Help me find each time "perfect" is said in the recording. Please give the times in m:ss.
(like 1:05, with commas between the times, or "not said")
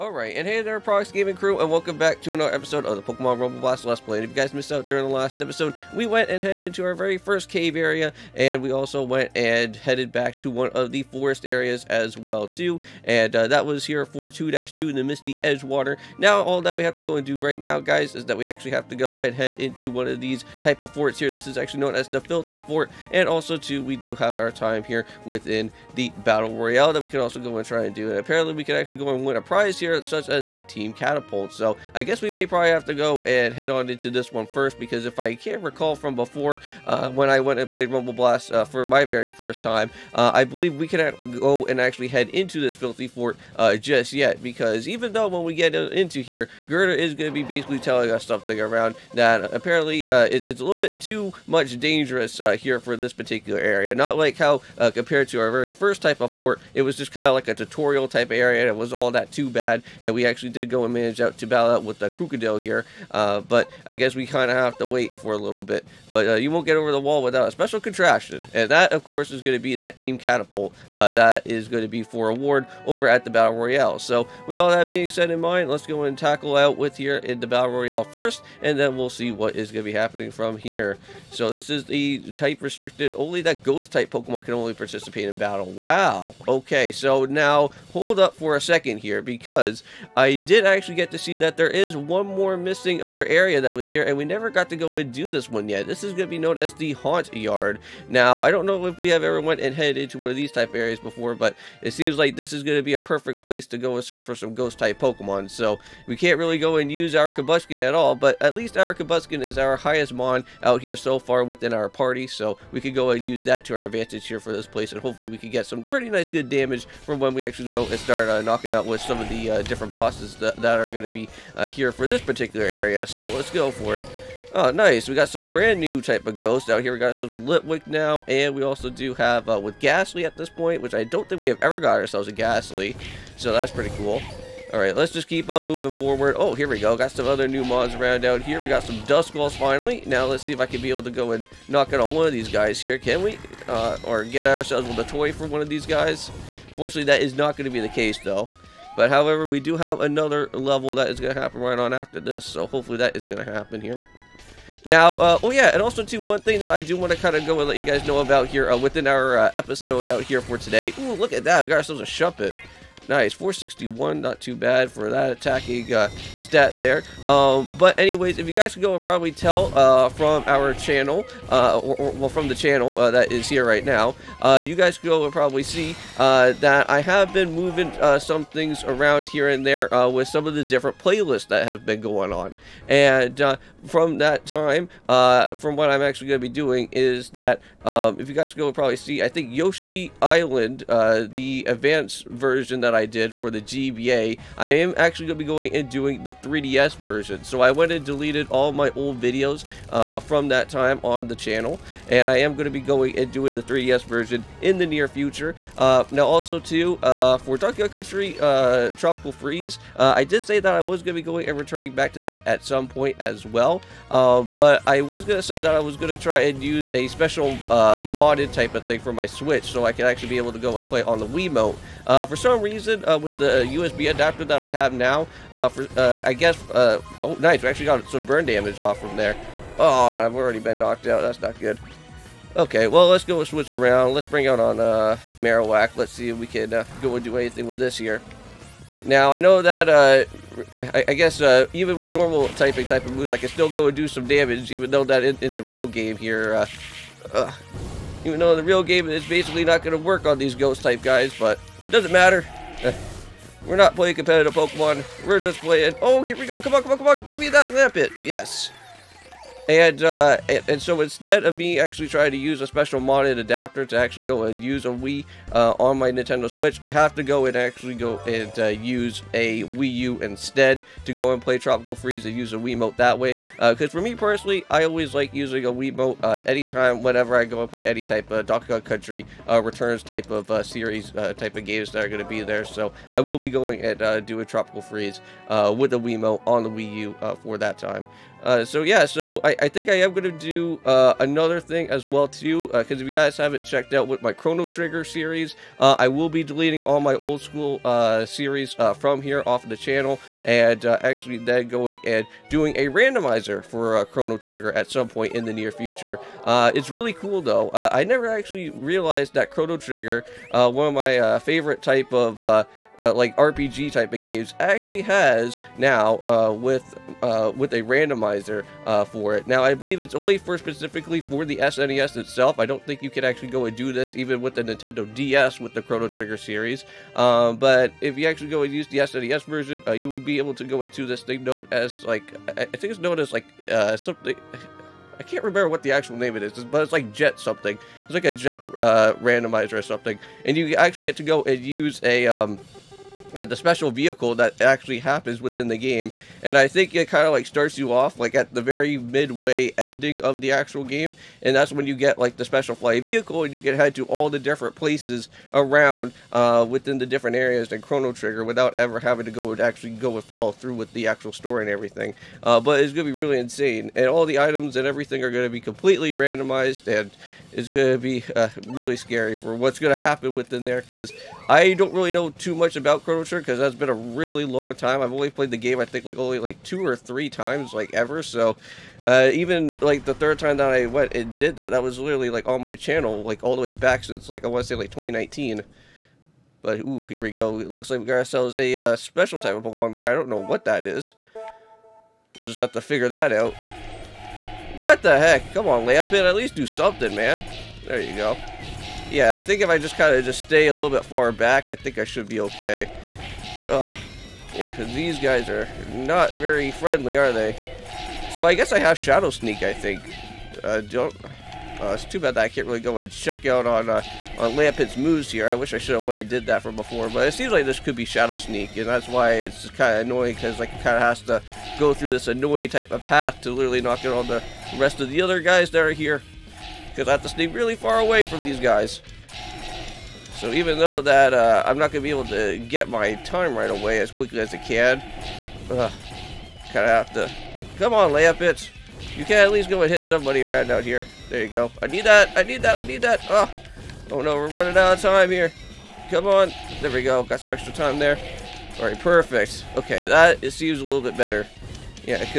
1:42, 7:28.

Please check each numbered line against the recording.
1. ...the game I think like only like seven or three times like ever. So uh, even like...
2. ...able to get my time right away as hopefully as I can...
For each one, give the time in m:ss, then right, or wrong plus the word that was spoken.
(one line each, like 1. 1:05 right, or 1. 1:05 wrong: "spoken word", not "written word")
1. 6:15 wrong: "two", not "seven"
2. 7:12 wrong: "quickly", not "hopefully".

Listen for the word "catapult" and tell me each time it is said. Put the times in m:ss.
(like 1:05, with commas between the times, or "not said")
0:30, 1:10.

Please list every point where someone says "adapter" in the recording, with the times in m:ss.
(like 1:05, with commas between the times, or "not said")
3:44, 4:23.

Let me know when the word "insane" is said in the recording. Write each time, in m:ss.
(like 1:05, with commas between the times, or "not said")
6:03.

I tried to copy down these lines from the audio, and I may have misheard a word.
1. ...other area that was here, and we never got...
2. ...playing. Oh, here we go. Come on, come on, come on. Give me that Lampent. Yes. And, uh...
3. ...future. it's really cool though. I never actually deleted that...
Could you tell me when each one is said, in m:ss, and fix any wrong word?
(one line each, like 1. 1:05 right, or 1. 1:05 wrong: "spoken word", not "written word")
1. 1:33 right
2. 4:15 right
3. 5:05 wrong: "realized", not "deleted".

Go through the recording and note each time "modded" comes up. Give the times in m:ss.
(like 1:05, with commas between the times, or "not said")
3:38, 4:22.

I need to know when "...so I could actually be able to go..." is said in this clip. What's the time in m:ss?
3:39.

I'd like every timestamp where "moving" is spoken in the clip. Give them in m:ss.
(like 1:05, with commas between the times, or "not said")
2:15, 2:57.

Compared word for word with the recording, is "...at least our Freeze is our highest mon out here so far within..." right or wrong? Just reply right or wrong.
wrong.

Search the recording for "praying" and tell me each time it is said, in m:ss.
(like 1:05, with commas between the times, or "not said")
not said.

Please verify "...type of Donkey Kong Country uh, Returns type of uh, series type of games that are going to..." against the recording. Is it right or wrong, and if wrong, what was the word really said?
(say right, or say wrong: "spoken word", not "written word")
right.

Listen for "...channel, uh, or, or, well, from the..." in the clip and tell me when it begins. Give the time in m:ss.
2:50.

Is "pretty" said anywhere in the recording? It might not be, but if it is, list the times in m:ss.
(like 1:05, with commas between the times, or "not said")
1:55, 2:13.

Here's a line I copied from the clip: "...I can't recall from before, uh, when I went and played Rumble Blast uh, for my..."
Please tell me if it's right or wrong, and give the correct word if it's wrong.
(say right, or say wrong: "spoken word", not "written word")
right.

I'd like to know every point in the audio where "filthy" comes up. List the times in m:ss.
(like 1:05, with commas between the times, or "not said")
0:22, 0:42.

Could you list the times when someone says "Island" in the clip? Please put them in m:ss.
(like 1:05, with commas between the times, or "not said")
3:10.